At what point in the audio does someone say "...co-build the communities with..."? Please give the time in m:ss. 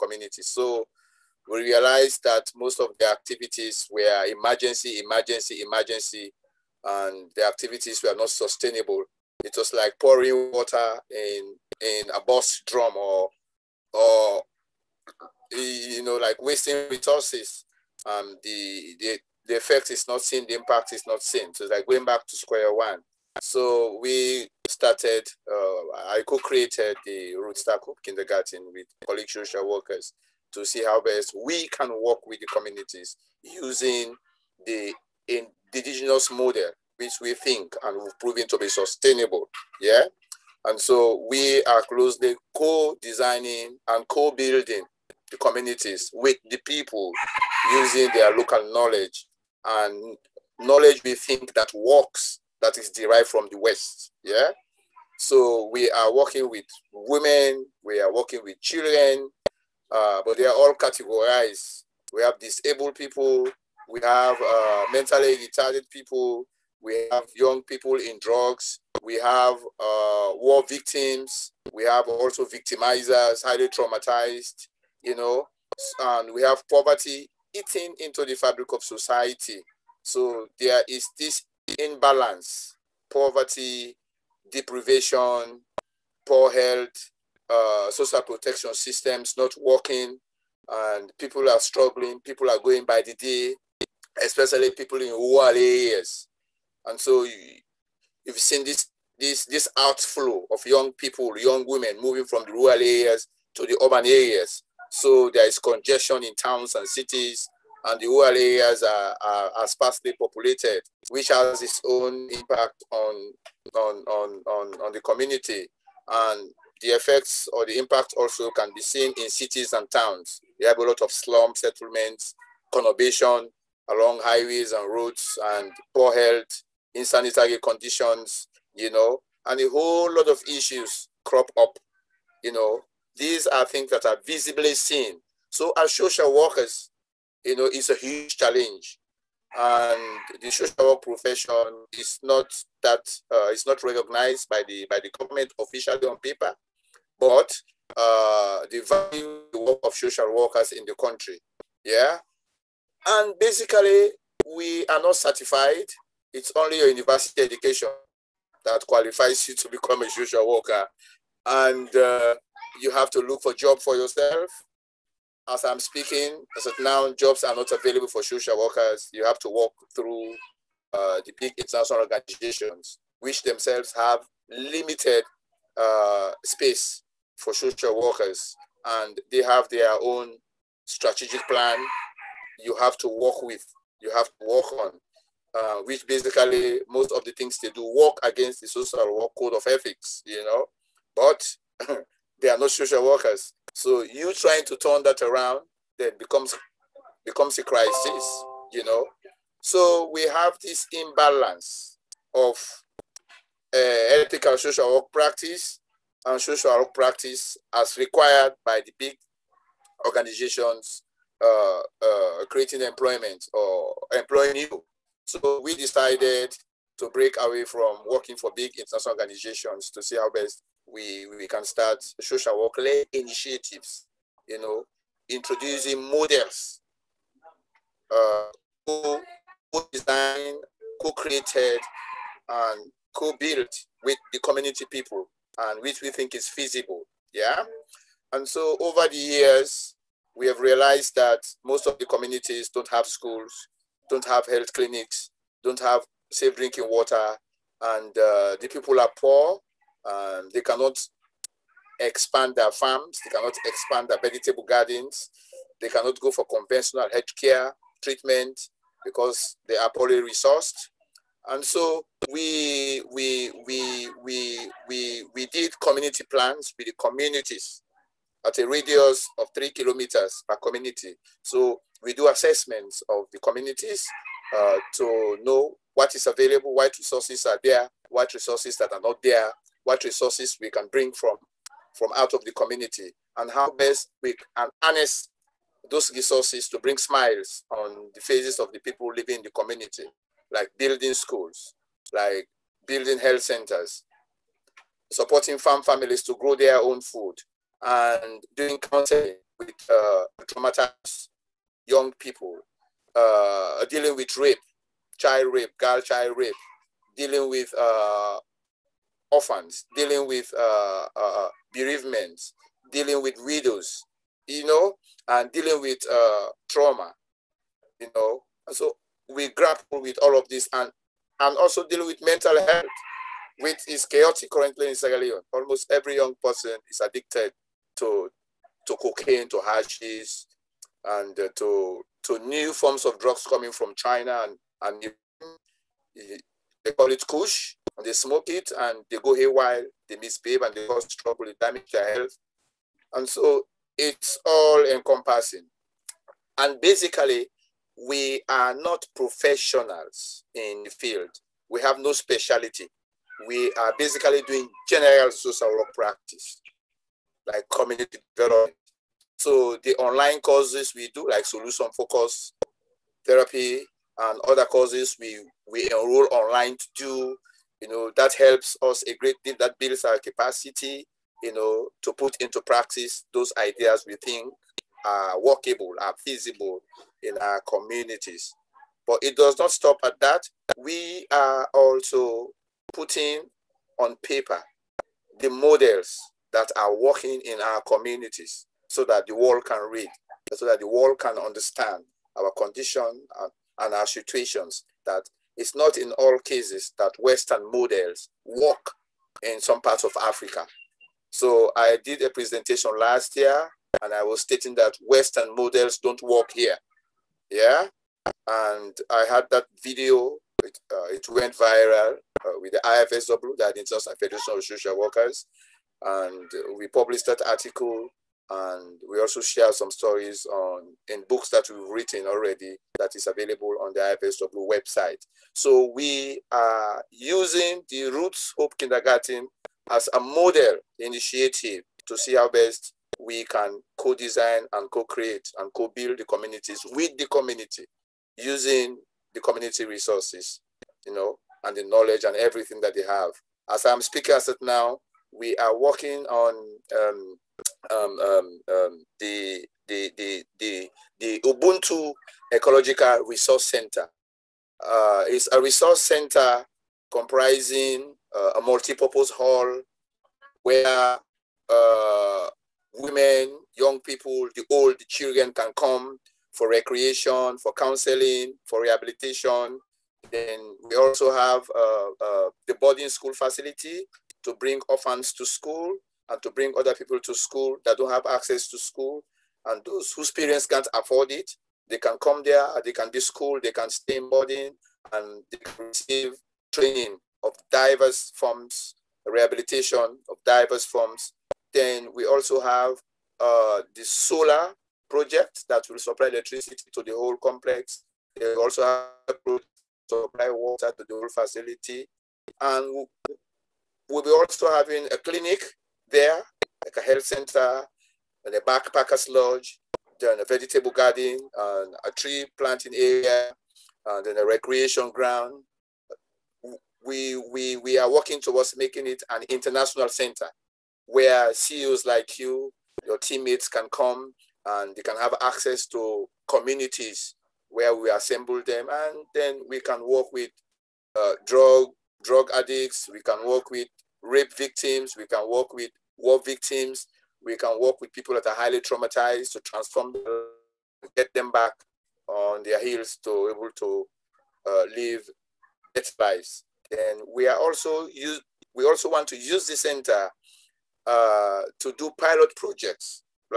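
7:15.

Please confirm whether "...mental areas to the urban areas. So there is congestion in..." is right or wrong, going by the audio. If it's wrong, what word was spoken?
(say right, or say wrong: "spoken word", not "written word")
wrong: "rural", not "mental".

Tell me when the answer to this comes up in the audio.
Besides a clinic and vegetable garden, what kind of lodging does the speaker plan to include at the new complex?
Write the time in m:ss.
8:28.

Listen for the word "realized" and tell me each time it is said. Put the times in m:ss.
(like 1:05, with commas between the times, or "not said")
0:01, 4:00.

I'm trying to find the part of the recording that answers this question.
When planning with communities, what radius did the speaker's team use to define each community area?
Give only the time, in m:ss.
4:29.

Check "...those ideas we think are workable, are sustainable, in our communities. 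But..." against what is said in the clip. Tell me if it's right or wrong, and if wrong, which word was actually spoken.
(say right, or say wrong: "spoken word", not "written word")
wrong: "feasible", not "sustainable".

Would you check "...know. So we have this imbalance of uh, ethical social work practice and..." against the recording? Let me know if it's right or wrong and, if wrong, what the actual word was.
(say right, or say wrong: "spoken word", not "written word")
right.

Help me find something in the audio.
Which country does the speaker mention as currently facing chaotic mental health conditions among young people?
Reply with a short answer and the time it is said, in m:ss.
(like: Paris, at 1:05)
Sierra Leone, at 5:24.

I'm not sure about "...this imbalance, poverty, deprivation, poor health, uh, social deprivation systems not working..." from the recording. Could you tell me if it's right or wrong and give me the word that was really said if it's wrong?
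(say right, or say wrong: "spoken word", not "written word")
wrong: "protection", not "deprivation".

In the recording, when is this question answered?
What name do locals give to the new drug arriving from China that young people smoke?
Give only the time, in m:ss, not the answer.
5:37.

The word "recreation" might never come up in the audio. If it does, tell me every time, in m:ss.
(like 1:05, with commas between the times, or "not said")
7:46, 8:34.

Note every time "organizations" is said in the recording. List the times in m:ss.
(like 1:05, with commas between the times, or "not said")
2:51, 3:30, 3:39.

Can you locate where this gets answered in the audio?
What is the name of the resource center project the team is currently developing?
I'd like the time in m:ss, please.
7:31.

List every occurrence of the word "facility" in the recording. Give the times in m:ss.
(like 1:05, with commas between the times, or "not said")
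7:53, 8:21.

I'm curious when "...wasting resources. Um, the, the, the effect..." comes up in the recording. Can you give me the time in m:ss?
0:16.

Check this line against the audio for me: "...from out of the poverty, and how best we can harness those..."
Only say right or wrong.
wrong.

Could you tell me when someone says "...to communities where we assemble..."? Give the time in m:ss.
8:45.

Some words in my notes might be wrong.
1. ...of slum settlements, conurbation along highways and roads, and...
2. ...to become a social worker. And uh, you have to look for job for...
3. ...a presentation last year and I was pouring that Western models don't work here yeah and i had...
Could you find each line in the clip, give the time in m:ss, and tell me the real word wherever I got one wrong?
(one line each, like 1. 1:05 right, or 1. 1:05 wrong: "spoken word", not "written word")
1. 2:00 right
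2. 2:39 right
3. 6:42 wrong: "stating", not "pouring".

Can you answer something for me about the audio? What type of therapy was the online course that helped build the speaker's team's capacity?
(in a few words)
solution focus therapy.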